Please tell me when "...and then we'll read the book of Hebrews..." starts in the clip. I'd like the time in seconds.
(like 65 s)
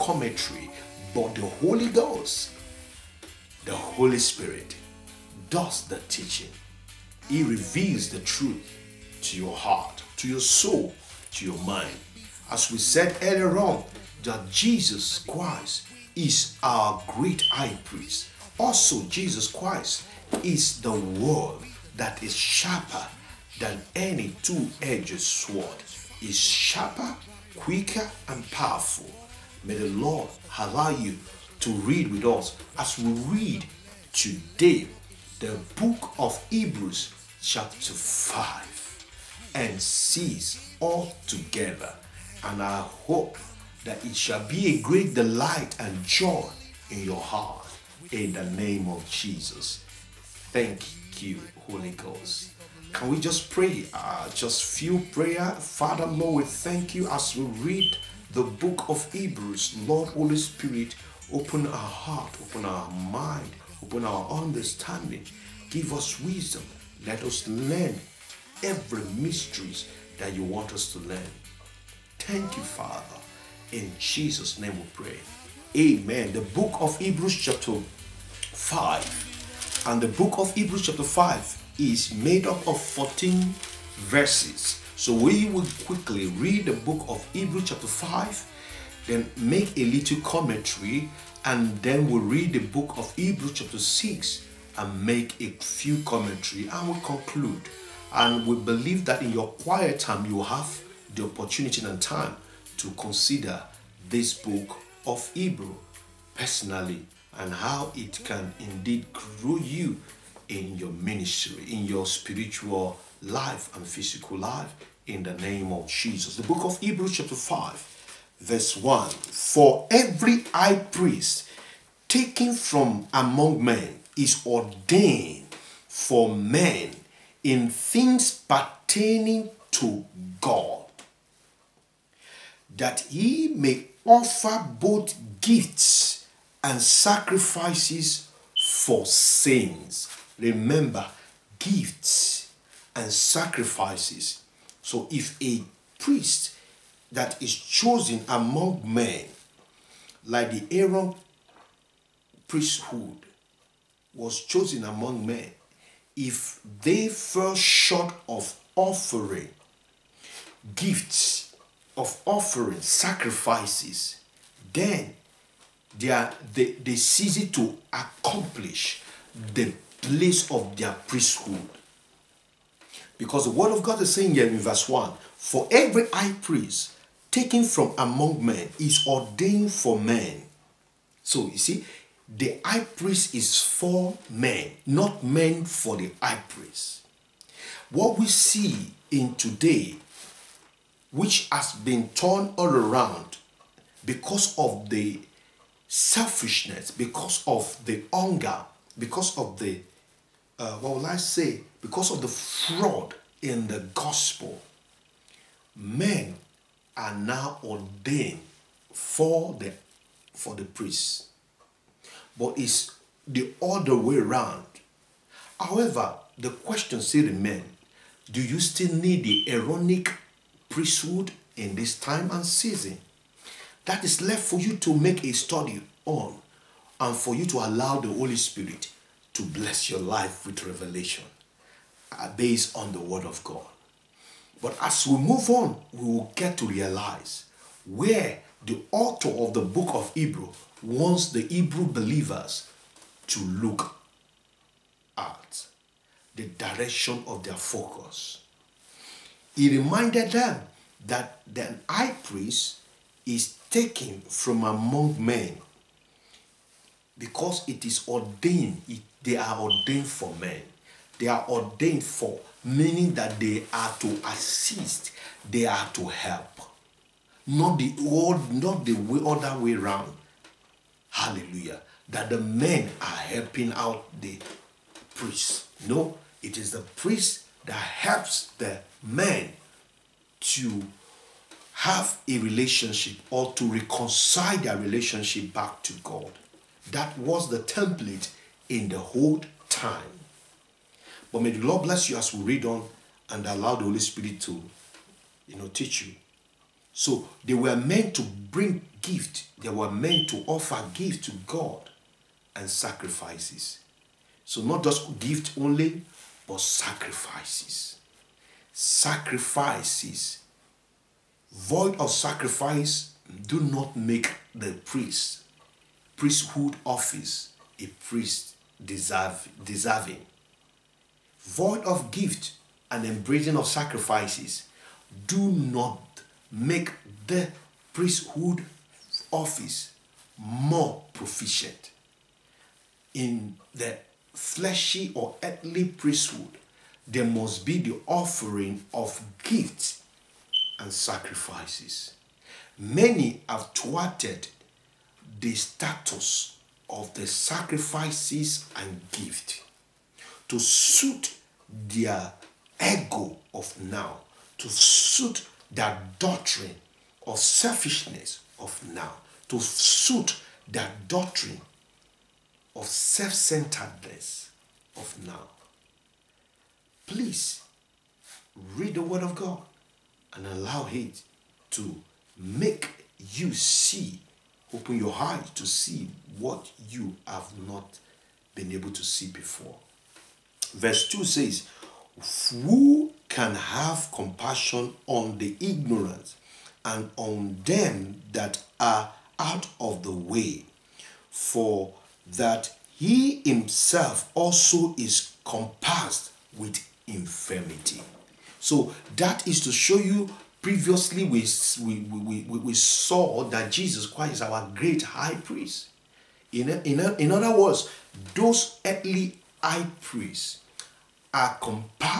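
91 s.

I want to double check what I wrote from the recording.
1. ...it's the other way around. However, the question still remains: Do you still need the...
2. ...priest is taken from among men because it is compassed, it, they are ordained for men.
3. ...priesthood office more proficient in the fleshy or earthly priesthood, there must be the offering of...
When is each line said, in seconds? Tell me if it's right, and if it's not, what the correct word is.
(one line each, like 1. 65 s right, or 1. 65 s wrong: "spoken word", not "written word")
1. 212 s right
2. 252 s wrong: "ordained", not "compassed"
3. 327 s right.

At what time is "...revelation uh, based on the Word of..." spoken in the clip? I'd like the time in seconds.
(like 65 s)
230 s.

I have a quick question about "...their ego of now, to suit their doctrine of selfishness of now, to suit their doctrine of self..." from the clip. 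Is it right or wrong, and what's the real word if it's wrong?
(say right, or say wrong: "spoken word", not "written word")
right.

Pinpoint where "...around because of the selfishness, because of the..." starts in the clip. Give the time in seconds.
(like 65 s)
192 s.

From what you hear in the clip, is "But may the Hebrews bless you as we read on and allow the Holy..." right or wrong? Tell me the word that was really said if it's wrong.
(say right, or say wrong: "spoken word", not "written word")
wrong: "Lord", not "Hebrews".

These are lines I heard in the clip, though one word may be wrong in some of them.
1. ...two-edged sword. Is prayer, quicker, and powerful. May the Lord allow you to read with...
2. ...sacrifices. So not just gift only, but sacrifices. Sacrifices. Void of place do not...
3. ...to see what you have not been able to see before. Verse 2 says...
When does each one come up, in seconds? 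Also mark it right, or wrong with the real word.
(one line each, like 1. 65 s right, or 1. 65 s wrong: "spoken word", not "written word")
1. 24 s wrong: "sharper", not "prayer"
2. 302 s wrong: "sacrifice", not "place"
3. 375 s right.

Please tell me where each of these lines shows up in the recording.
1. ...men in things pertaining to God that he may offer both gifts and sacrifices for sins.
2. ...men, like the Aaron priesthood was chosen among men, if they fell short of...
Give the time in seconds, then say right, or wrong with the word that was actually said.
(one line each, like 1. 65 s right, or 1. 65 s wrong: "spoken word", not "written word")
1. 126 s right
2. 148 s right.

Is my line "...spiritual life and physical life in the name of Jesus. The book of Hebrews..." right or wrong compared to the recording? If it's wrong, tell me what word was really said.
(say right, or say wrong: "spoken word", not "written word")
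right.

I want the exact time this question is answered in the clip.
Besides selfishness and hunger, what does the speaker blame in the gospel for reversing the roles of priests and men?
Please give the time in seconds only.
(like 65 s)
202 s.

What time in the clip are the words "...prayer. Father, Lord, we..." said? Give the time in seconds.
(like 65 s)
55 s.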